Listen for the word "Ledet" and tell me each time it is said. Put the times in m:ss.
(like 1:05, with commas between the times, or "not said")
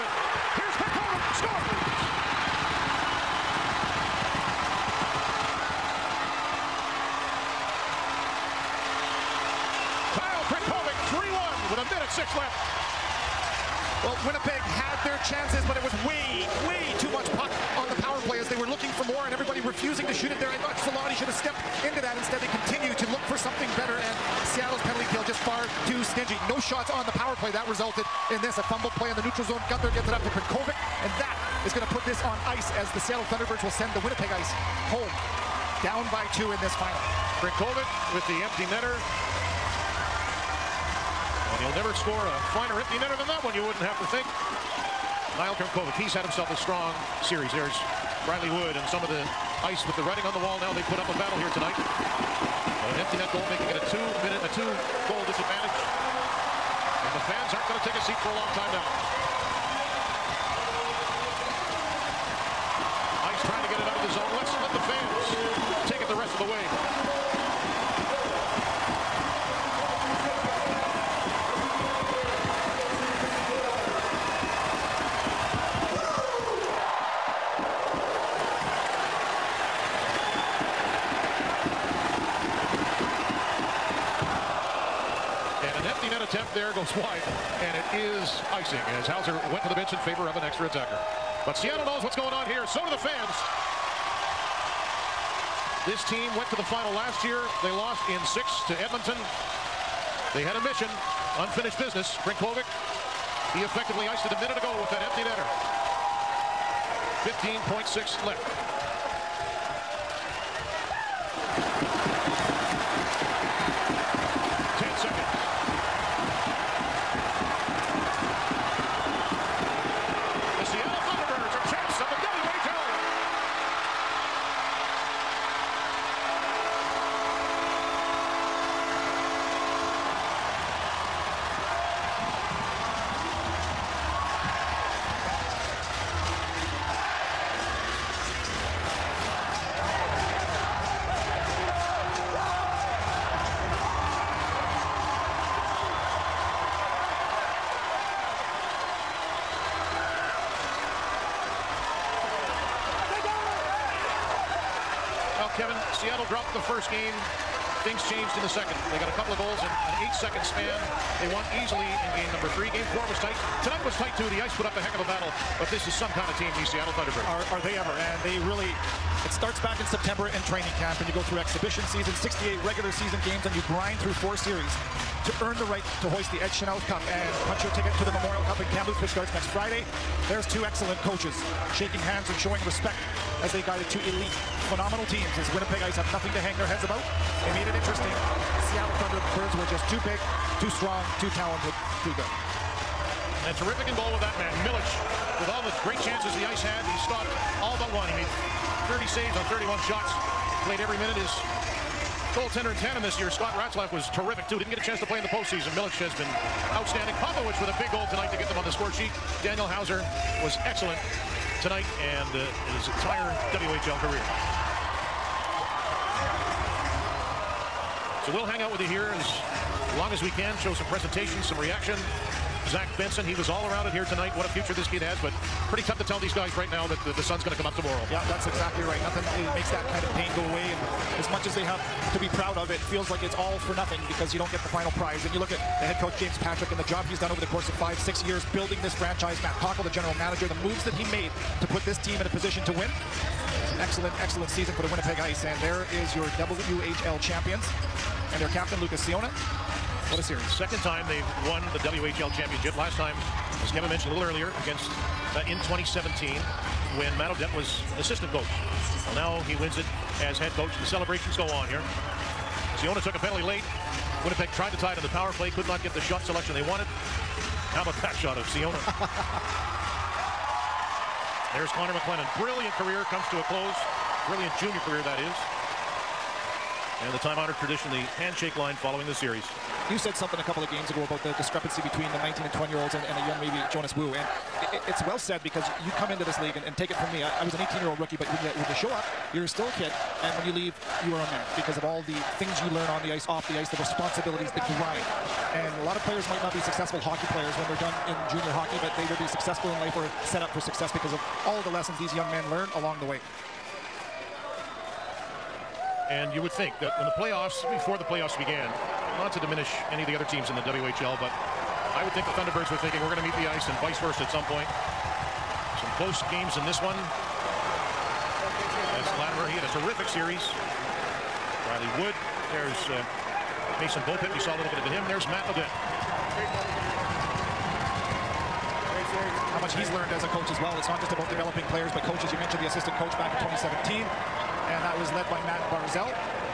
5:25.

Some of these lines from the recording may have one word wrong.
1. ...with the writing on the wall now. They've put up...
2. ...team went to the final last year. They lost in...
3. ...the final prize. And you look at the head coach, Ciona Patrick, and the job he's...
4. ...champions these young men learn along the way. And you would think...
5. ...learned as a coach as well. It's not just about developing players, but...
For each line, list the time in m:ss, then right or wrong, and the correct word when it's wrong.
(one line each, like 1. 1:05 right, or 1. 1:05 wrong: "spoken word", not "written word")
1. 0:49 right
2. 1:36 right
3. 3:54 wrong: "James", not "Ciona"
4. 5:01 wrong: "lessons", not "champions"
5. 5:29 right.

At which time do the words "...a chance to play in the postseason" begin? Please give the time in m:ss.
3:24.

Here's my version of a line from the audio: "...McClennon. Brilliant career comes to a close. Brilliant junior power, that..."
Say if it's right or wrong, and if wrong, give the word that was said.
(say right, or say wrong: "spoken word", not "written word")
wrong: "career", not "power".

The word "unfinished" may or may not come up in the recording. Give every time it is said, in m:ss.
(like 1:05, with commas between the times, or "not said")
1:41.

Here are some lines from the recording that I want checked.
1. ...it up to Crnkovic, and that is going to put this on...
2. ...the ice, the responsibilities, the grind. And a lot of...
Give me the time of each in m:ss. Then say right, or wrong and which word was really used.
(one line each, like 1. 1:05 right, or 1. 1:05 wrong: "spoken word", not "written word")
1. 0:30 right
2. 4:53 right.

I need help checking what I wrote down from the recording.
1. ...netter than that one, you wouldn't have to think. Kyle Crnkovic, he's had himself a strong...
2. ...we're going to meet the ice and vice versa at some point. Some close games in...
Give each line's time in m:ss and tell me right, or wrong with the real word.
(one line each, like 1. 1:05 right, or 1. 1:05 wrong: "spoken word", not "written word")
1. 0:42 right
2. 5:13 right.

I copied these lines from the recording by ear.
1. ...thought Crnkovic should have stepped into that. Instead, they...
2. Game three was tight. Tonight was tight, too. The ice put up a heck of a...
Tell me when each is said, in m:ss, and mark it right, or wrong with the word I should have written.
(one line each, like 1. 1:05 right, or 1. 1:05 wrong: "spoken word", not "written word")
1. 0:20 wrong: "Solani", not "Crnkovic"
2. 2:42 wrong: "four", not "three".